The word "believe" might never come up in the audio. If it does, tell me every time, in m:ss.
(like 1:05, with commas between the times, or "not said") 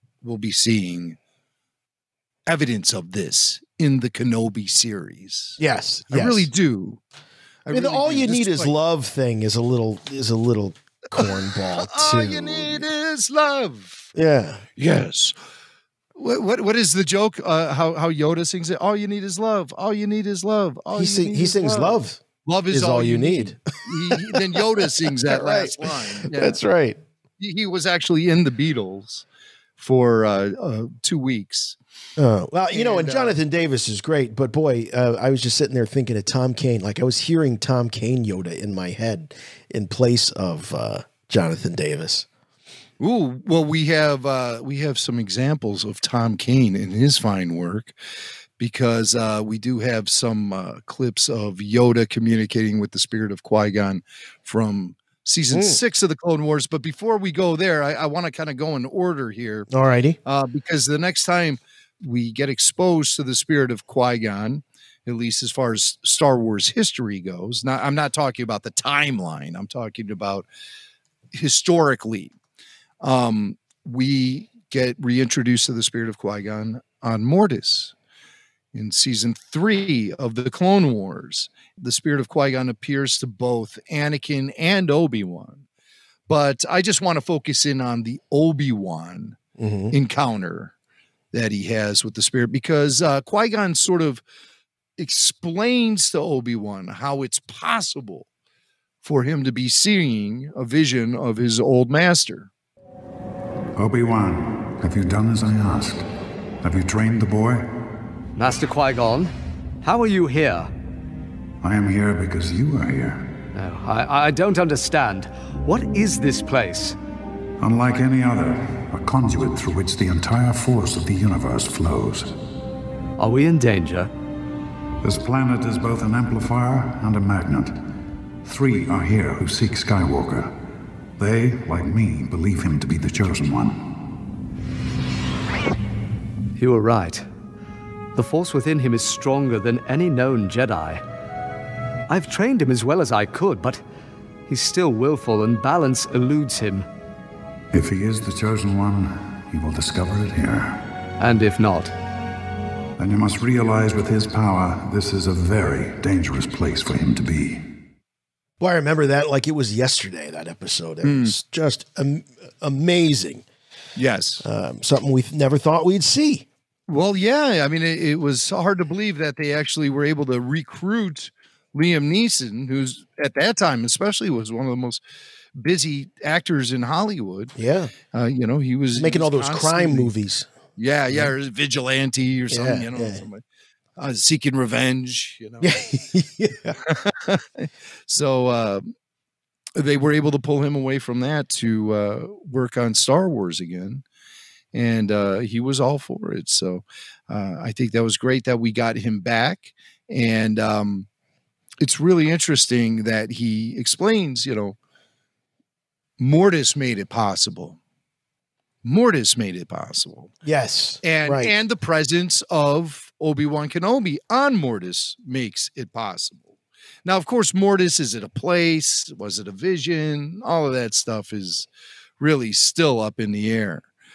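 2:12, 2:48.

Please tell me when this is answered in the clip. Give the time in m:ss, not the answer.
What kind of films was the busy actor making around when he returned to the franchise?
2:59.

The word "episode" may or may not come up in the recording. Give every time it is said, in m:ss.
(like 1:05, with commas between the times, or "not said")
2:40.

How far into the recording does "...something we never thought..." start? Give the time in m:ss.
2:44.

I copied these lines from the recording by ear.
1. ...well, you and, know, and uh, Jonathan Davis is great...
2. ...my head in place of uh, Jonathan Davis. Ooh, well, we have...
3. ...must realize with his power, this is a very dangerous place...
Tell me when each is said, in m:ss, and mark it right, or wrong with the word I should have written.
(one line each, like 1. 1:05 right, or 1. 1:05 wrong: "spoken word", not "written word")
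1. 0:32 right
2. 0:38 right
3. 2:33 right.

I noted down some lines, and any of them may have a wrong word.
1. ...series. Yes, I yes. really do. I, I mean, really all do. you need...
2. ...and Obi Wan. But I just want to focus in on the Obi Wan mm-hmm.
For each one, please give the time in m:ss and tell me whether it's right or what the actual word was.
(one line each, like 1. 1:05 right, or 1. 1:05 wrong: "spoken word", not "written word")
1. 0:04 right
2. 1:24 right.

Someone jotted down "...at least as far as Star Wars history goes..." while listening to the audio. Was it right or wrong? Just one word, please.
right.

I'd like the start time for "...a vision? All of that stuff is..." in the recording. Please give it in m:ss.
3:39.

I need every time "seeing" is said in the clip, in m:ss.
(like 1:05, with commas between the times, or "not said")
0:00, 1:39.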